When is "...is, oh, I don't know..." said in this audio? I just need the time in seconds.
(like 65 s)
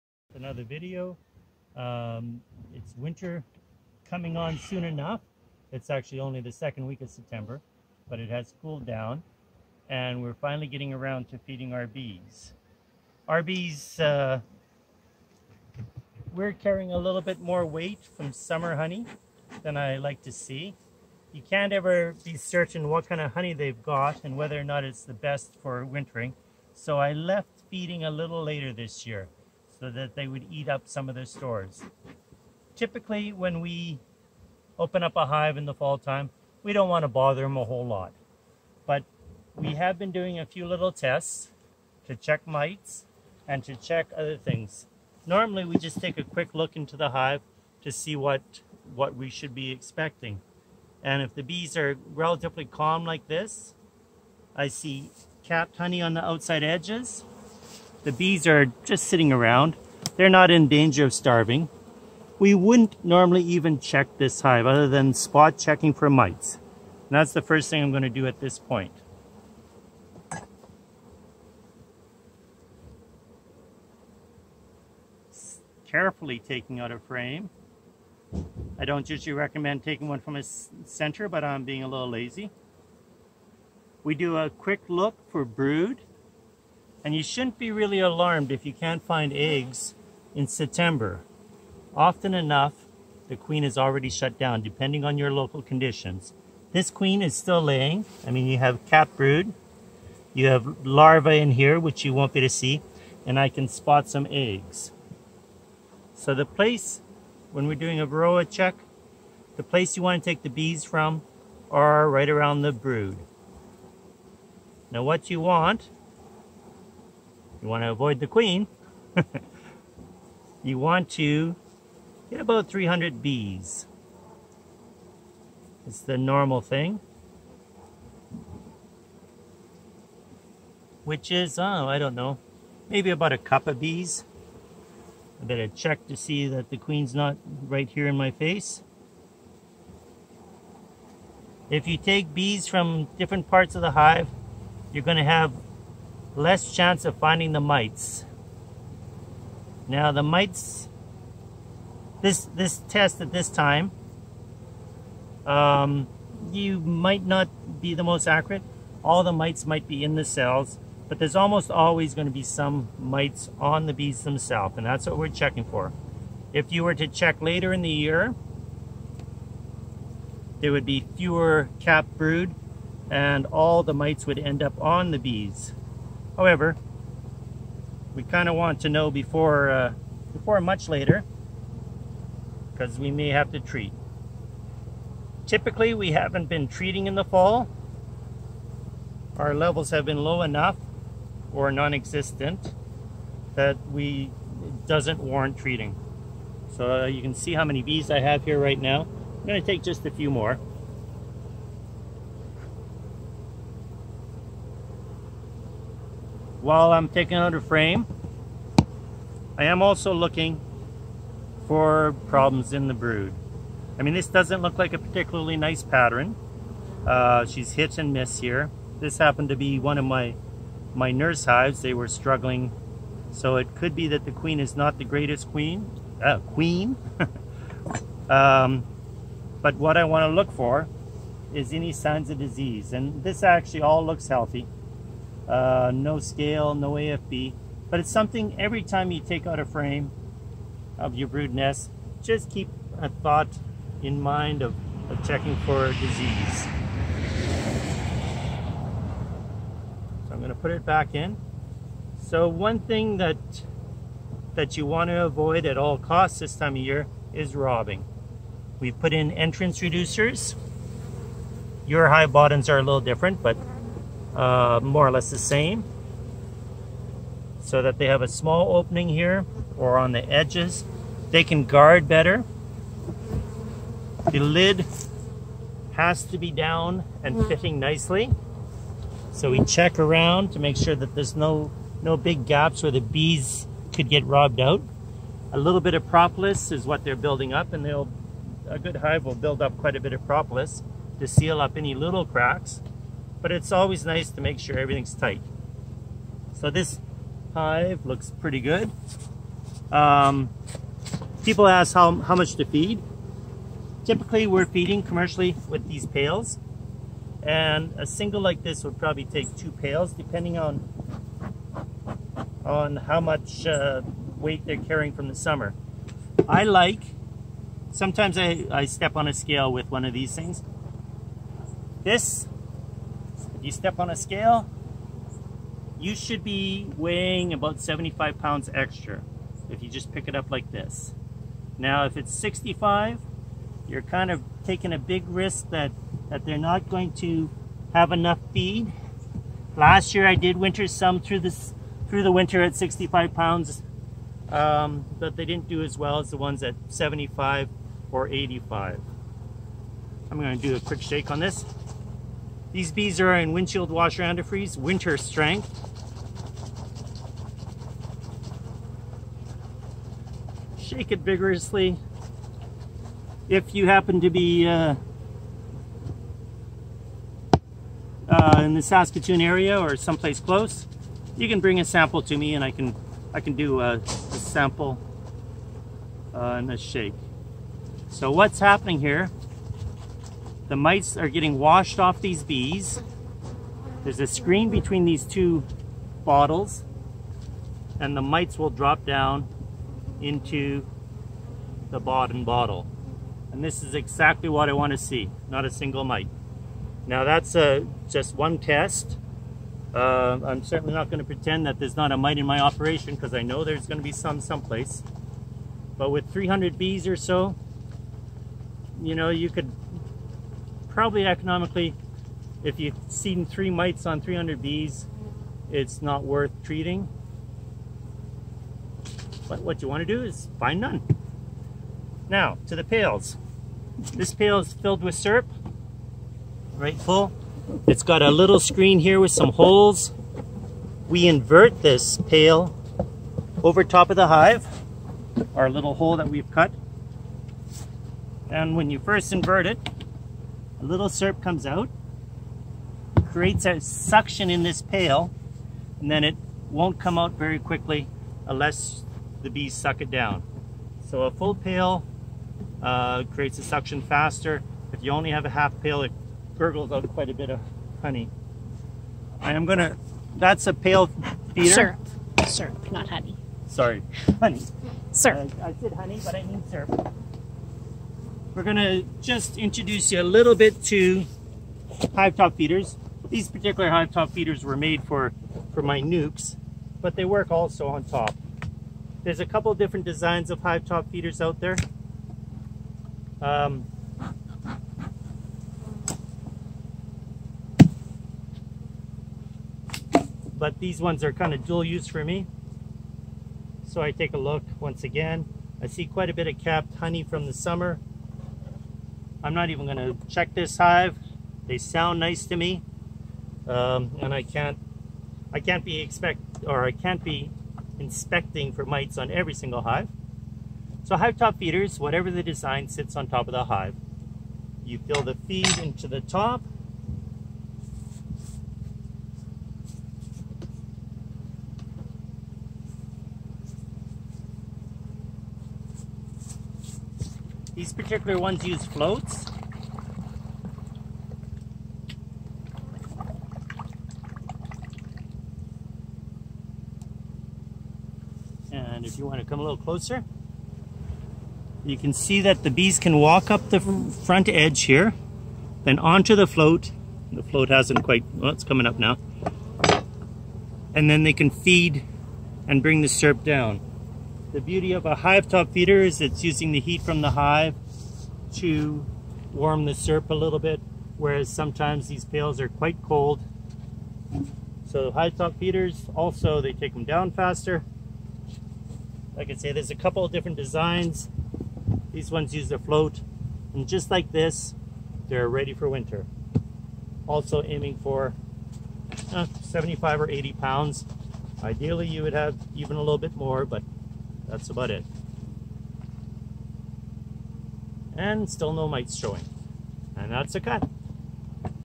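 131 s.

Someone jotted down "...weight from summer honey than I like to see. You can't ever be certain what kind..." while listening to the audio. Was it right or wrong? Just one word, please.
right.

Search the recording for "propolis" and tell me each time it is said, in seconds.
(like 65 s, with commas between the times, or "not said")
286 s, 290 s.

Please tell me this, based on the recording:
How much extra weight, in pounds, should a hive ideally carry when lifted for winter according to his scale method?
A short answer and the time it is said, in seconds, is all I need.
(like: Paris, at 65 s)
75 pounds, at 327 s.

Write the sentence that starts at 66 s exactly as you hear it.
And that's the first thing I'm going to do at this point.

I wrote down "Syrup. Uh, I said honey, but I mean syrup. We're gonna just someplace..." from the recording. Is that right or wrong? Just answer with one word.
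wrong.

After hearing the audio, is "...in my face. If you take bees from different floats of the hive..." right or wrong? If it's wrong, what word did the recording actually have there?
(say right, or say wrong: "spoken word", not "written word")
wrong: "parts", not "floats".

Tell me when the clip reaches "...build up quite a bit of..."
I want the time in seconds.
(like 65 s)
289 s.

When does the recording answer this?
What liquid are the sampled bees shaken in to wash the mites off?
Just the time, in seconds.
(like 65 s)
353 s.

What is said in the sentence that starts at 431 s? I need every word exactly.
We invert this pail over top of the hive, our little hole that we've cut.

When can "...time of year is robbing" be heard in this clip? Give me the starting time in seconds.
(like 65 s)
256 s.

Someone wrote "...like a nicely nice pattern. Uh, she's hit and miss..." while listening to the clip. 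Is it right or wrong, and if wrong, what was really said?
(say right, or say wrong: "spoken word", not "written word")
wrong: "particularly", not "nicely".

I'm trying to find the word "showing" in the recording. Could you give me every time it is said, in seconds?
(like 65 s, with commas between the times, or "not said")
589 s.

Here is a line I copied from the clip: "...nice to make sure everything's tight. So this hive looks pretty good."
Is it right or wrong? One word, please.
right.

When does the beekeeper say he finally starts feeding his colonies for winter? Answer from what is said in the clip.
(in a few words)
Second week of September.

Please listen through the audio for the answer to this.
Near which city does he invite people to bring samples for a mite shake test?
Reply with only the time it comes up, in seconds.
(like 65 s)
368 s.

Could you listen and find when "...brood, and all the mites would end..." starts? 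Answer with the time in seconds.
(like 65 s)
172 s.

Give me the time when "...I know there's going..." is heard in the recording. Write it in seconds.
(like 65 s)
403 s.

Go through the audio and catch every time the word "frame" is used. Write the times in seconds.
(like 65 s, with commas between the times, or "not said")
76 s, 207 s, 239 s.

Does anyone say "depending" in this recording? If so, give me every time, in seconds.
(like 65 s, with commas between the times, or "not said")
94 s, 310 s.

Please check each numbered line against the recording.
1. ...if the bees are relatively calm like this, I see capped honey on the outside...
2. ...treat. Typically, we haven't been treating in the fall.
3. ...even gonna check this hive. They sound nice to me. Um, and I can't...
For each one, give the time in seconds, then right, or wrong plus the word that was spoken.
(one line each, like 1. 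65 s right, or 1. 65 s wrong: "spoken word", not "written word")
1. 51 s right
2. 183 s right
3. 499 s right.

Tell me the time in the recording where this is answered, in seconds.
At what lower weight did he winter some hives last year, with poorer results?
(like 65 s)
342 s.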